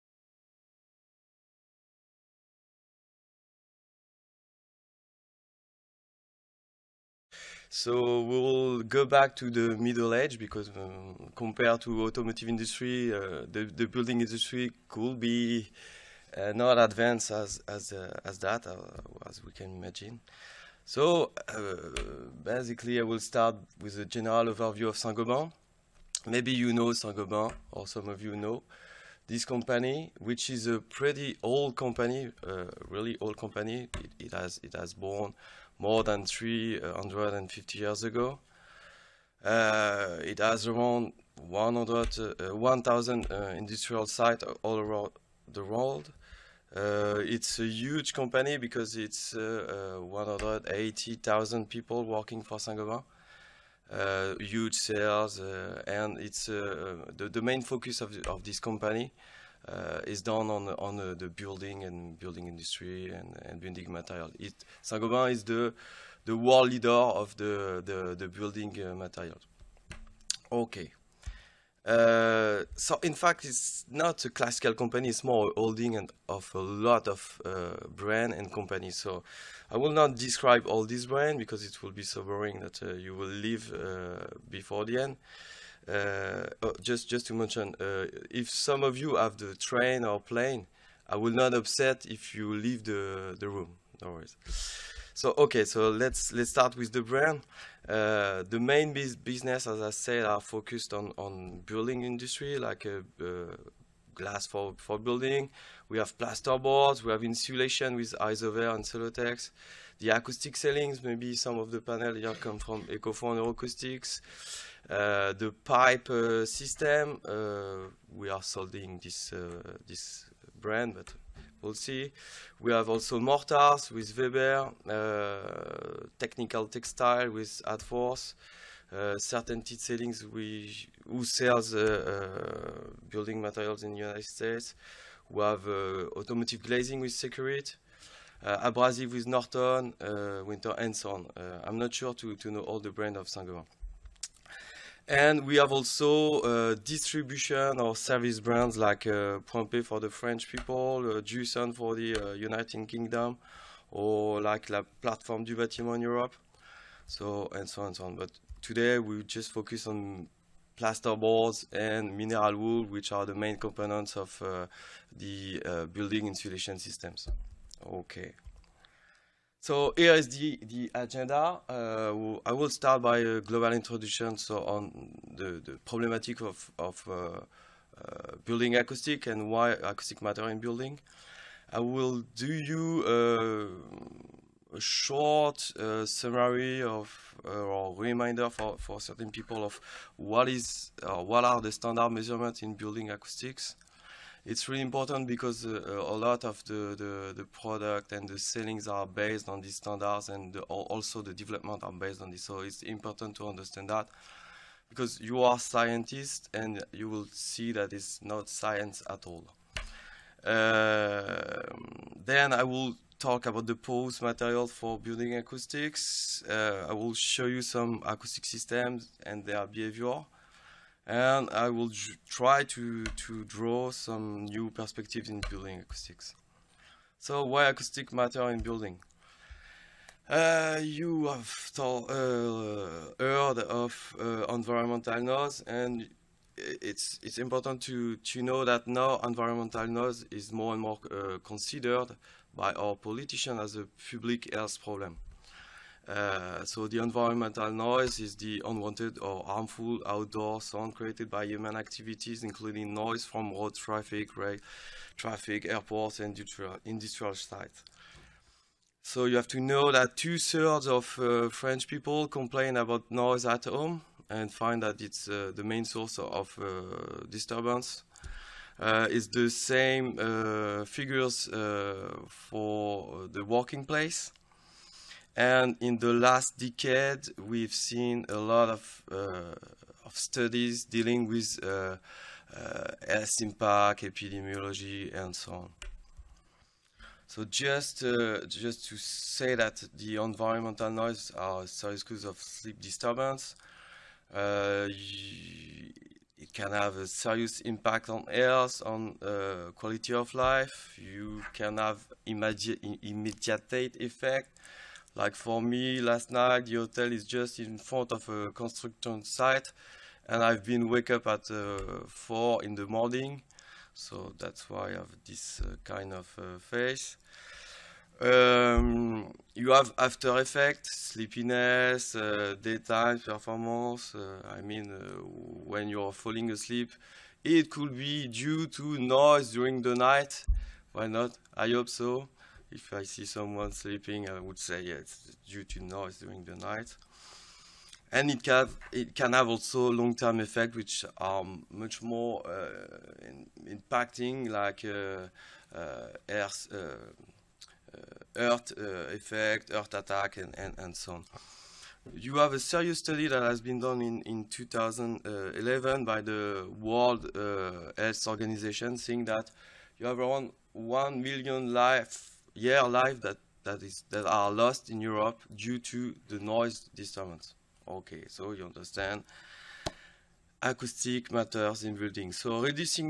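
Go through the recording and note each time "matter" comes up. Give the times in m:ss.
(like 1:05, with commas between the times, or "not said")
3:00, 3:48, 6:11.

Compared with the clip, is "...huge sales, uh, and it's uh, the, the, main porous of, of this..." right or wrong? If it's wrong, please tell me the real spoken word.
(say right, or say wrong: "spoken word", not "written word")
wrong: "focus", not "porous".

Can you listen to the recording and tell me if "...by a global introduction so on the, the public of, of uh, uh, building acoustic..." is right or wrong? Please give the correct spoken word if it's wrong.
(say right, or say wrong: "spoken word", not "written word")
wrong: "problematic", not "public".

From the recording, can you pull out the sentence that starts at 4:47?
So just uh, just to say that the environmental noise are serious cause of sleep disturbance.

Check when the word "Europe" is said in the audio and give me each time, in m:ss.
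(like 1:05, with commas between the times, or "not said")
2:36, 6:05.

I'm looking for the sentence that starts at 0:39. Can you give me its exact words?
Uh, it has around 100, uh, 1,000 uh, industrial sites all around the world.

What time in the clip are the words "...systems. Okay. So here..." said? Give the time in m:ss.
2:46.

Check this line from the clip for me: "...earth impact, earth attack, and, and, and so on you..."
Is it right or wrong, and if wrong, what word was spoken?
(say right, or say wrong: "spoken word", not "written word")
wrong: "effect", not "impact".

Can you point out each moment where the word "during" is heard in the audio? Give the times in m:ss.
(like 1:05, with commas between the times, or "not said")
5:29, 5:36.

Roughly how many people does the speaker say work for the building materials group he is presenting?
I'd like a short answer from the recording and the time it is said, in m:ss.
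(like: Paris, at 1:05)
180,000, at 0:49.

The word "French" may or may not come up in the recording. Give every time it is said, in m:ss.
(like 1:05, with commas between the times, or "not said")
2:30, 4:21.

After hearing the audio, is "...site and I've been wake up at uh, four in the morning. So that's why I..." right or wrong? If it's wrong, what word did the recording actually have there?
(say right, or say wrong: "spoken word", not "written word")
right.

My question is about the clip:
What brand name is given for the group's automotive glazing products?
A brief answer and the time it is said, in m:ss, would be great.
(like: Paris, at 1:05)
Securit, at 2:17.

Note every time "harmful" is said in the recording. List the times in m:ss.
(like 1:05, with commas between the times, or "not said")
4:09.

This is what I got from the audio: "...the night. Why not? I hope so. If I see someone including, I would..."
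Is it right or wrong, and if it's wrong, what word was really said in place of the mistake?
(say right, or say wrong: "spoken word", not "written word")
wrong: "sleeping", not "including".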